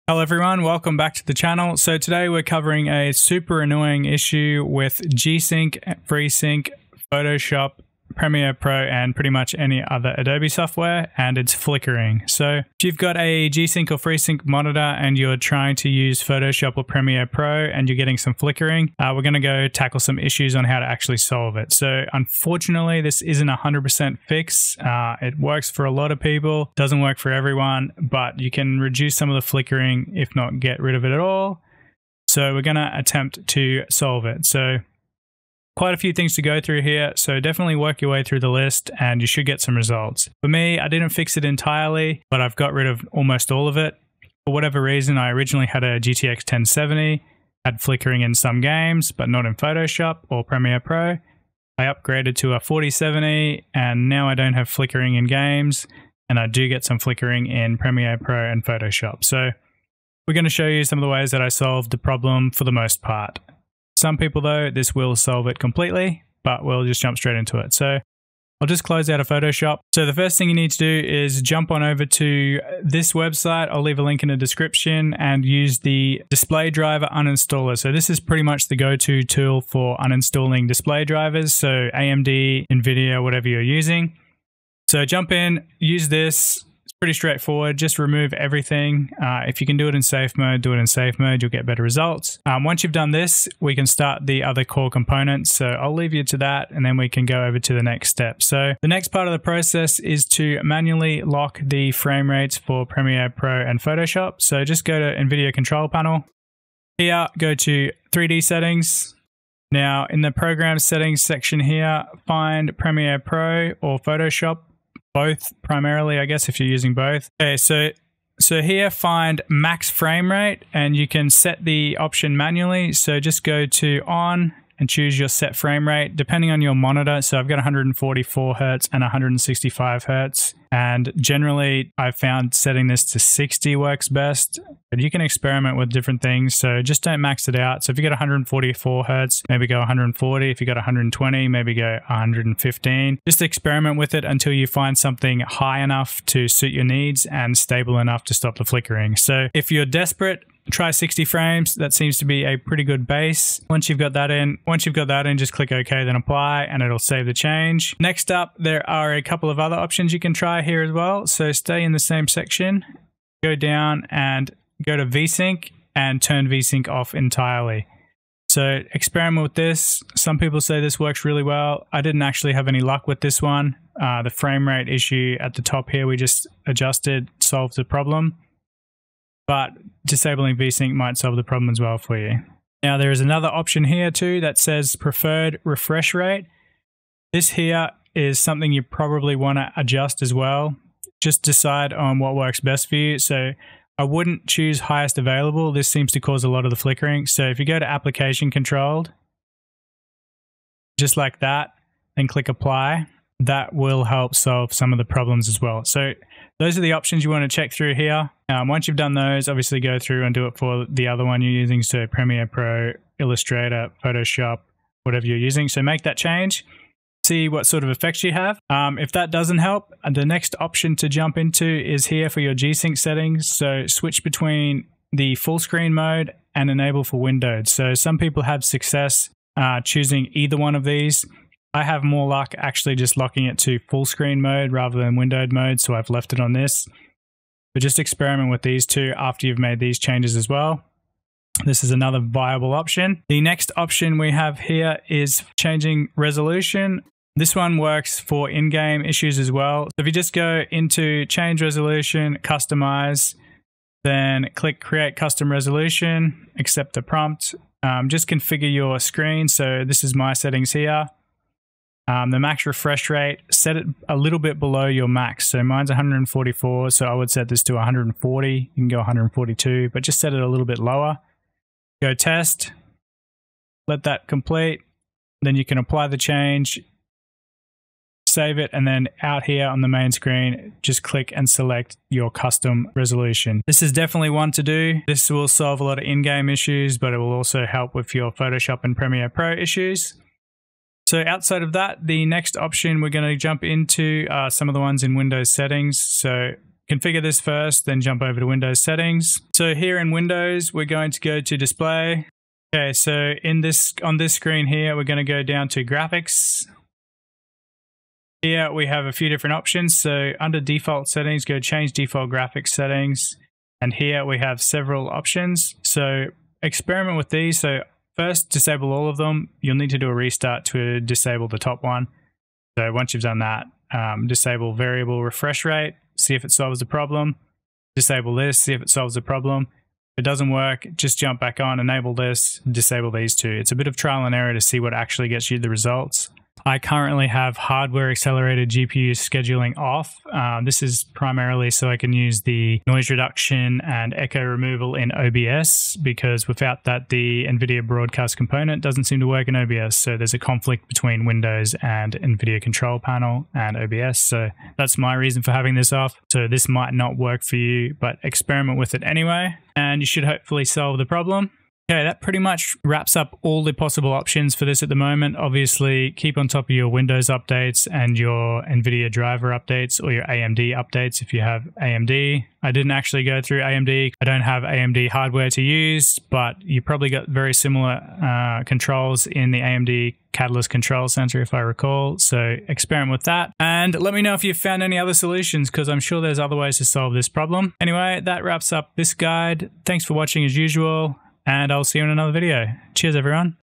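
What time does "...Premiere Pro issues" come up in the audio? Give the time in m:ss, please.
4:48.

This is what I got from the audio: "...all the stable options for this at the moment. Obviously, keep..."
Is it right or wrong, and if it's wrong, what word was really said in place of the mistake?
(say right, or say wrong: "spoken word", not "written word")
wrong: "possible", not "stable".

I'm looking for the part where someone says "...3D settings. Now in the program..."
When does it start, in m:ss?
1:48.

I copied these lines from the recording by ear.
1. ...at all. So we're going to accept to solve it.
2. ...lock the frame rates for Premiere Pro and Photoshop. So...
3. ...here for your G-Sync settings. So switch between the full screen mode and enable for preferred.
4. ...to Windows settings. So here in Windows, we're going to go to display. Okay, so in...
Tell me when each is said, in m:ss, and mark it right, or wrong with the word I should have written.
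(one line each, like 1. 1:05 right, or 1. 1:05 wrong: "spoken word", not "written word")
1. 0:31 wrong: "attempt", not "accept"
2. 1:41 right
3. 3:42 wrong: "windowed", not "preferred"
4. 4:58 right.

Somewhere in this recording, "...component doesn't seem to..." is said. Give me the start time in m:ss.
5:48.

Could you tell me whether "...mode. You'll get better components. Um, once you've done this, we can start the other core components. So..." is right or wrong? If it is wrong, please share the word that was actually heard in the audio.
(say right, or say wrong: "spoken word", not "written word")
wrong: "results", not "components".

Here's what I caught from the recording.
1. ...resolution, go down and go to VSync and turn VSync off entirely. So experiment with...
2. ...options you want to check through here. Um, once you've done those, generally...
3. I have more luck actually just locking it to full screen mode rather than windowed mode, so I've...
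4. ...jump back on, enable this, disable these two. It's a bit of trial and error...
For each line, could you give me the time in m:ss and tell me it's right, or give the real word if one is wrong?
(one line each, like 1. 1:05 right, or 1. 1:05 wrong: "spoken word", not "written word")
1. 2:42 wrong: "section", not "resolution"
2. 3:26 wrong: "obviously", not "generally"
3. 3:51 right
4. 5:31 right.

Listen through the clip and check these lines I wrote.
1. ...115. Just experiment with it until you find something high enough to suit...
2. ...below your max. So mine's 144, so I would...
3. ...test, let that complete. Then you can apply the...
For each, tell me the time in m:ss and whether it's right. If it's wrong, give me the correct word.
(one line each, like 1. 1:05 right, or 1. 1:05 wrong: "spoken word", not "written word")
1. 2:22 right
2. 4:24 right
3. 4:32 right.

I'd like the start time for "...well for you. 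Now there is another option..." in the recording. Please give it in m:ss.
3:01.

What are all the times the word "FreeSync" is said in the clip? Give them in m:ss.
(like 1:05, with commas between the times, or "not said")
0:06, 0:13.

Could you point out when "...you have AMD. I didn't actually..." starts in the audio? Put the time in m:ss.
6:11.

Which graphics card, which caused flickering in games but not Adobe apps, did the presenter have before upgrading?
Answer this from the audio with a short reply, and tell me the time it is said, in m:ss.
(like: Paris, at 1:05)
GTX 1070, at 0:45.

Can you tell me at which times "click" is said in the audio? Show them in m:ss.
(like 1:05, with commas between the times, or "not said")
2:35, 3:22, 4:14, 4:41.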